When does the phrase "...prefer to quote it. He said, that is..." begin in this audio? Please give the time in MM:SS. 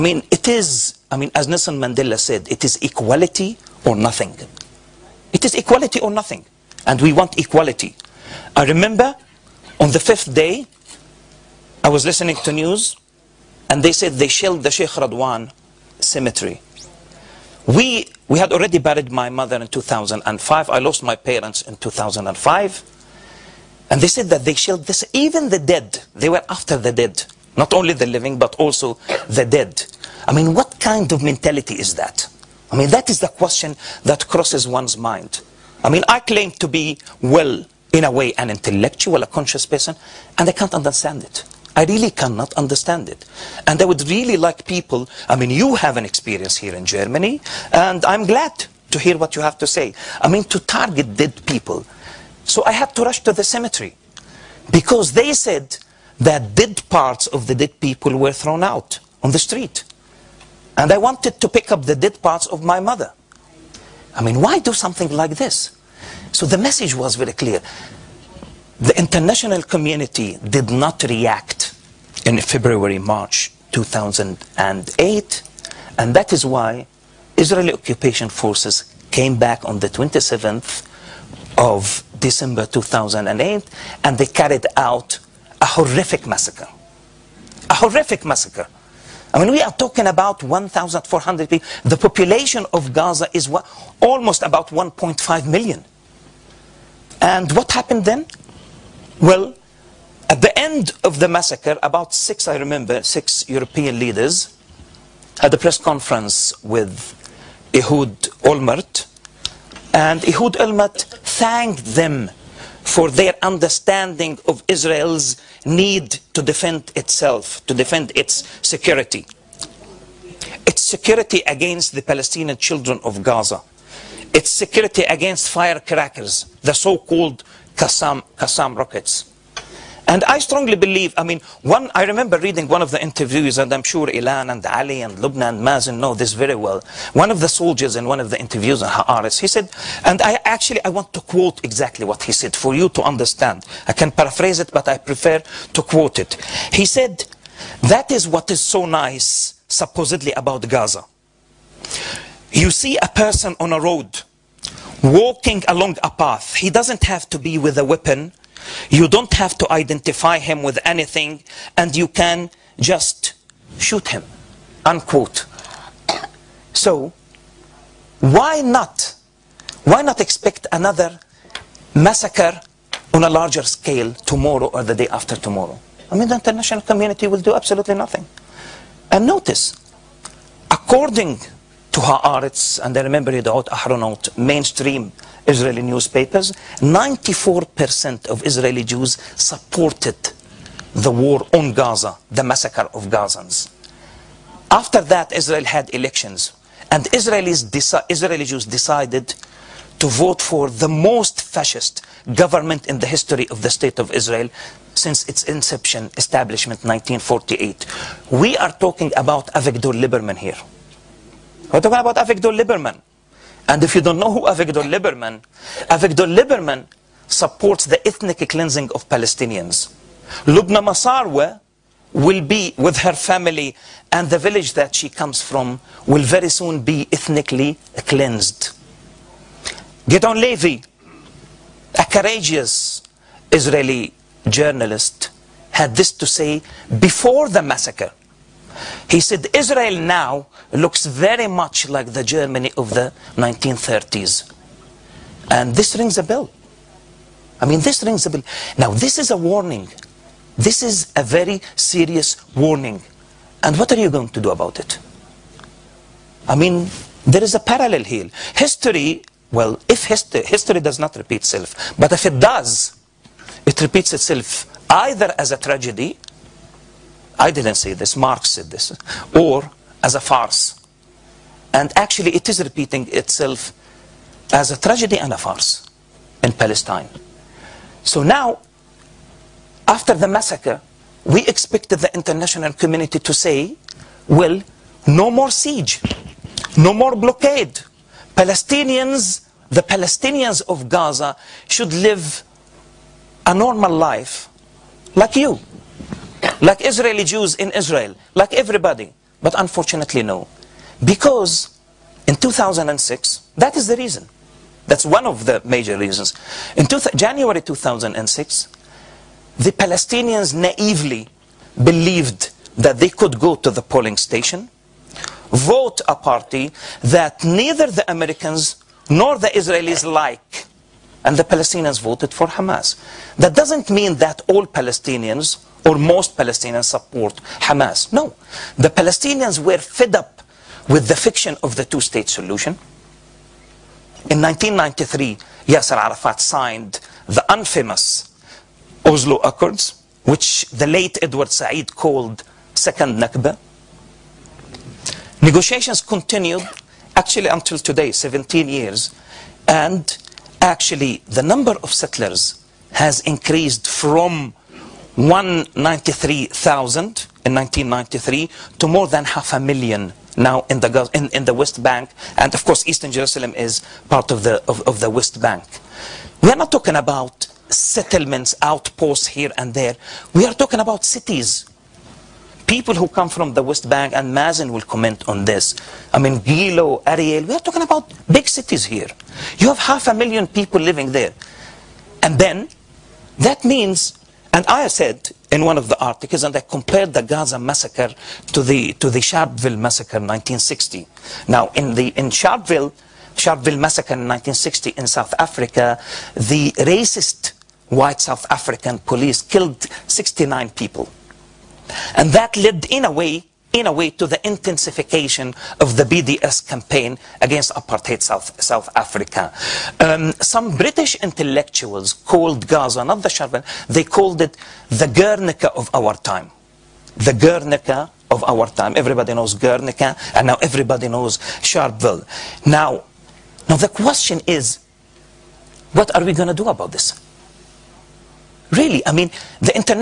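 02:24.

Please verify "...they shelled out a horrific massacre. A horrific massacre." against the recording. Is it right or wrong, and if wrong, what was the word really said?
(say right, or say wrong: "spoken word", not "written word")
wrong: "carried", not "shelled".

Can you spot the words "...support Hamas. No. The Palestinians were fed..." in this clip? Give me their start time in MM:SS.
05:26.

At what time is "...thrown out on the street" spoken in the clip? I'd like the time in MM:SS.
00:58.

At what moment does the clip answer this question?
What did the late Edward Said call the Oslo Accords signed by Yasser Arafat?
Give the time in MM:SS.
05:42.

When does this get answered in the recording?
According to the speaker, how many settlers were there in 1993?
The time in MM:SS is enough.
05:55.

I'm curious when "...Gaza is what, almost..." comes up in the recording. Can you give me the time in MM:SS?
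01:32.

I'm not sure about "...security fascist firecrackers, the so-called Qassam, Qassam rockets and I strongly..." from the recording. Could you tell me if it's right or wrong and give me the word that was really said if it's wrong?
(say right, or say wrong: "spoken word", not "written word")
wrong: "against", not "fascist".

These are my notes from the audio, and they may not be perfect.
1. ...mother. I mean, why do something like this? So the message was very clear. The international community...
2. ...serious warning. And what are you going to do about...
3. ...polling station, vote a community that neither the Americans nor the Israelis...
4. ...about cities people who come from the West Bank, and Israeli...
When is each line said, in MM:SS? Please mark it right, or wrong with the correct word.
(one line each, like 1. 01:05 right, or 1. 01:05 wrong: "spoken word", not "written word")
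1. 01:02 right
2. 04:11 right
3. 05:13 wrong: "party", not "community"
4. 06:10 wrong: "Mazin", not "Israeli".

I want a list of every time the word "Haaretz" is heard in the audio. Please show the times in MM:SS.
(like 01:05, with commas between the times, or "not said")
02:18, 03:02.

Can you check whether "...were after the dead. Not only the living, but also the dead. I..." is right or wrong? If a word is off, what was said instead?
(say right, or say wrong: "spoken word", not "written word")
right.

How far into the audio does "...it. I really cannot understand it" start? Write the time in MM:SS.
00:41.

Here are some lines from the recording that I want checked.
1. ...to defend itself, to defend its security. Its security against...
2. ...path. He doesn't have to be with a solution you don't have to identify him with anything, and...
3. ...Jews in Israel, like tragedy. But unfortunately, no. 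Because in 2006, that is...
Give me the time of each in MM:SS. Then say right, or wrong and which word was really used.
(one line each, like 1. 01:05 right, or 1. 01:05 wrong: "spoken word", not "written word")
1. 01:56 right
2. 02:36 wrong: "weapon", not "solution"
3. 04:57 wrong: "everybody", not "tragedy".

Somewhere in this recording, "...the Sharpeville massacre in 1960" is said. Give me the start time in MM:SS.
06:29.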